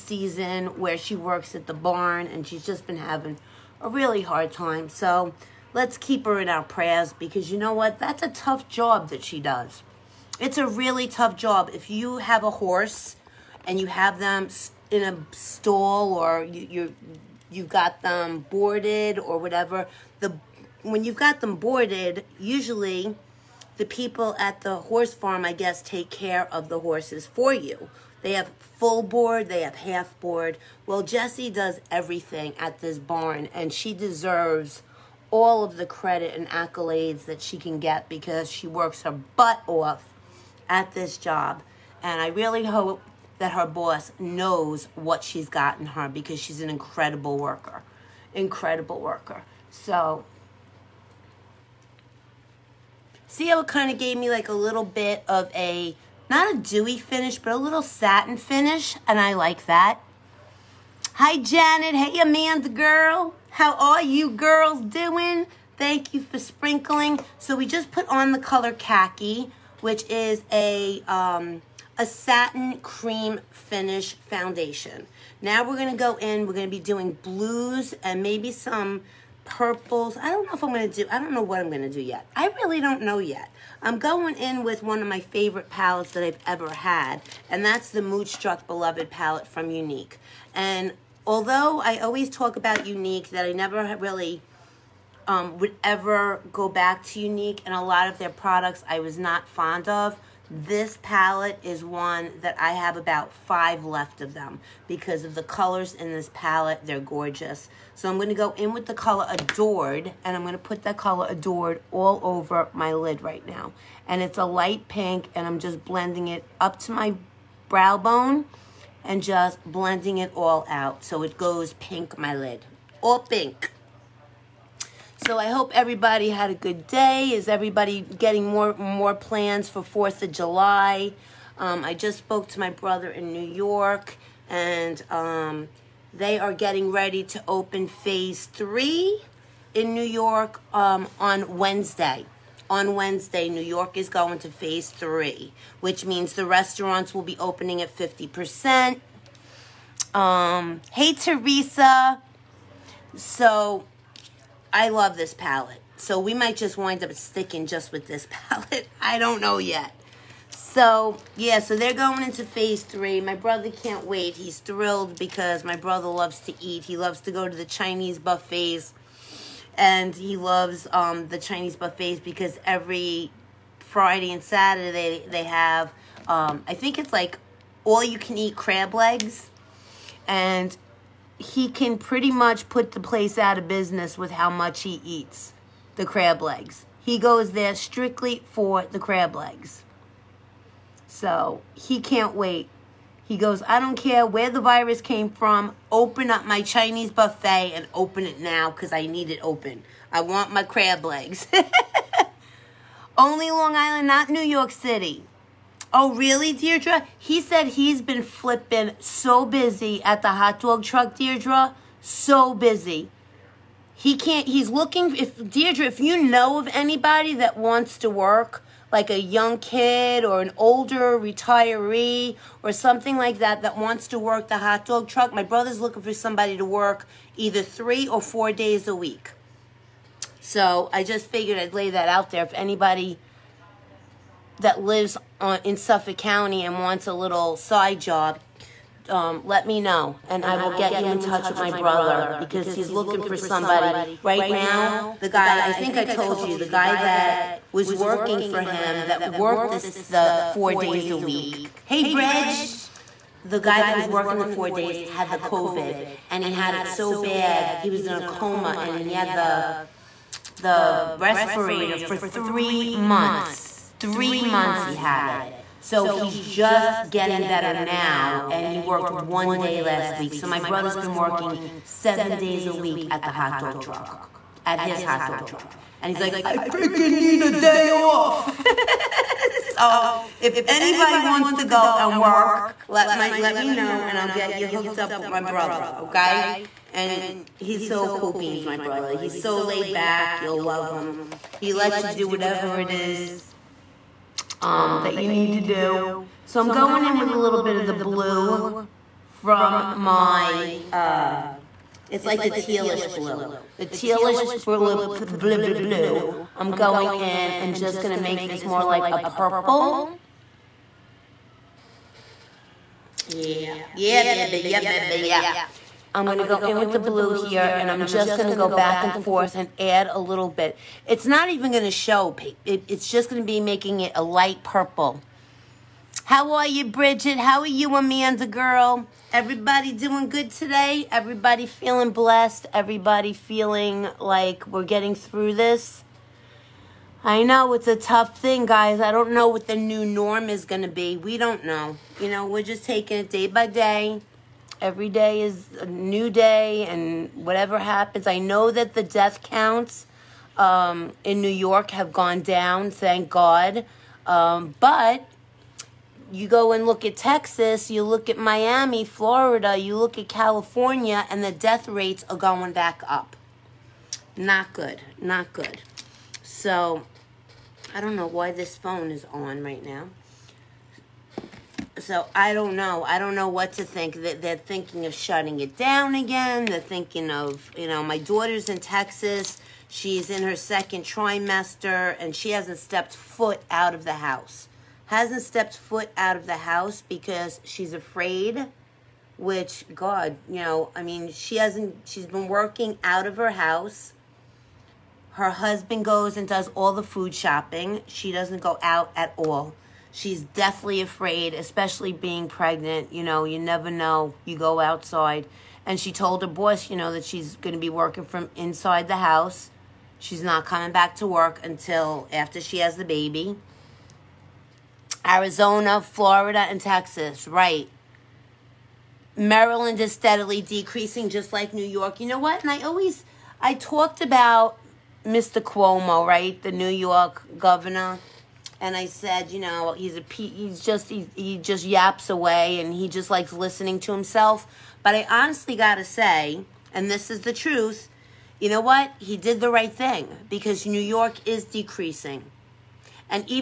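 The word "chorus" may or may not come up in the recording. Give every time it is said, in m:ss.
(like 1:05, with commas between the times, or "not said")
not said.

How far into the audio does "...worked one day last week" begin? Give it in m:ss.
4:28.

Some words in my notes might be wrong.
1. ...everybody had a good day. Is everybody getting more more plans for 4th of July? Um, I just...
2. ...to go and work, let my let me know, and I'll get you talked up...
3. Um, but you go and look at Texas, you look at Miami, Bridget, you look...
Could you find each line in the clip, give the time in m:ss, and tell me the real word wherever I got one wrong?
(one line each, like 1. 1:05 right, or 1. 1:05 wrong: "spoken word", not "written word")
1. 2:05 right
2. 4:41 wrong: "hooked", not "talked"
3. 5:54 wrong: "Florida", not "Bridget".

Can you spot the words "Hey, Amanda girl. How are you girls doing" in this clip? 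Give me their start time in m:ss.
1:01.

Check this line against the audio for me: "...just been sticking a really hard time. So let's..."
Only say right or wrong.
wrong.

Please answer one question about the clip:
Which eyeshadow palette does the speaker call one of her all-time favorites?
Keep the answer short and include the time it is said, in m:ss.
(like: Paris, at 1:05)
Moodstruck Beloved, at 1:27.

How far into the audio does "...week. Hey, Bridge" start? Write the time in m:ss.
4:11.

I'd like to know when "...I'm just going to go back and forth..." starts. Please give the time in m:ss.
5:17.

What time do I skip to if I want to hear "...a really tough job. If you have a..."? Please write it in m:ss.
0:10.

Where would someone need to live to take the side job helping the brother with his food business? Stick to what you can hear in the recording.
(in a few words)
Suffolk County.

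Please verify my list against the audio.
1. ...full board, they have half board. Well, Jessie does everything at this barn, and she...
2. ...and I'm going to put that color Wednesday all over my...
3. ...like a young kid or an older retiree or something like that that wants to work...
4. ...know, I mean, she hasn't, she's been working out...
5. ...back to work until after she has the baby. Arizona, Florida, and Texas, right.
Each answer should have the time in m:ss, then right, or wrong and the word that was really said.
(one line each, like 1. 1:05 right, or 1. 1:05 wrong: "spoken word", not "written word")
1. 0:28 right
2. 1:50 wrong: "Adored", not "Wednesday"
3. 3:38 right
4. 6:30 right
5. 6:50 right.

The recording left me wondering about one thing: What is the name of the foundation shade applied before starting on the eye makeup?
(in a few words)
Khaki.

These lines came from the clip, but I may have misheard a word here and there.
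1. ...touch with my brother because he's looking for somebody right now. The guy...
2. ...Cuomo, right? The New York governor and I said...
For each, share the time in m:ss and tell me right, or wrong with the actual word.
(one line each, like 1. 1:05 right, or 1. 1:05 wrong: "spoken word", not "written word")
1. 4:01 right
2. 7:05 right.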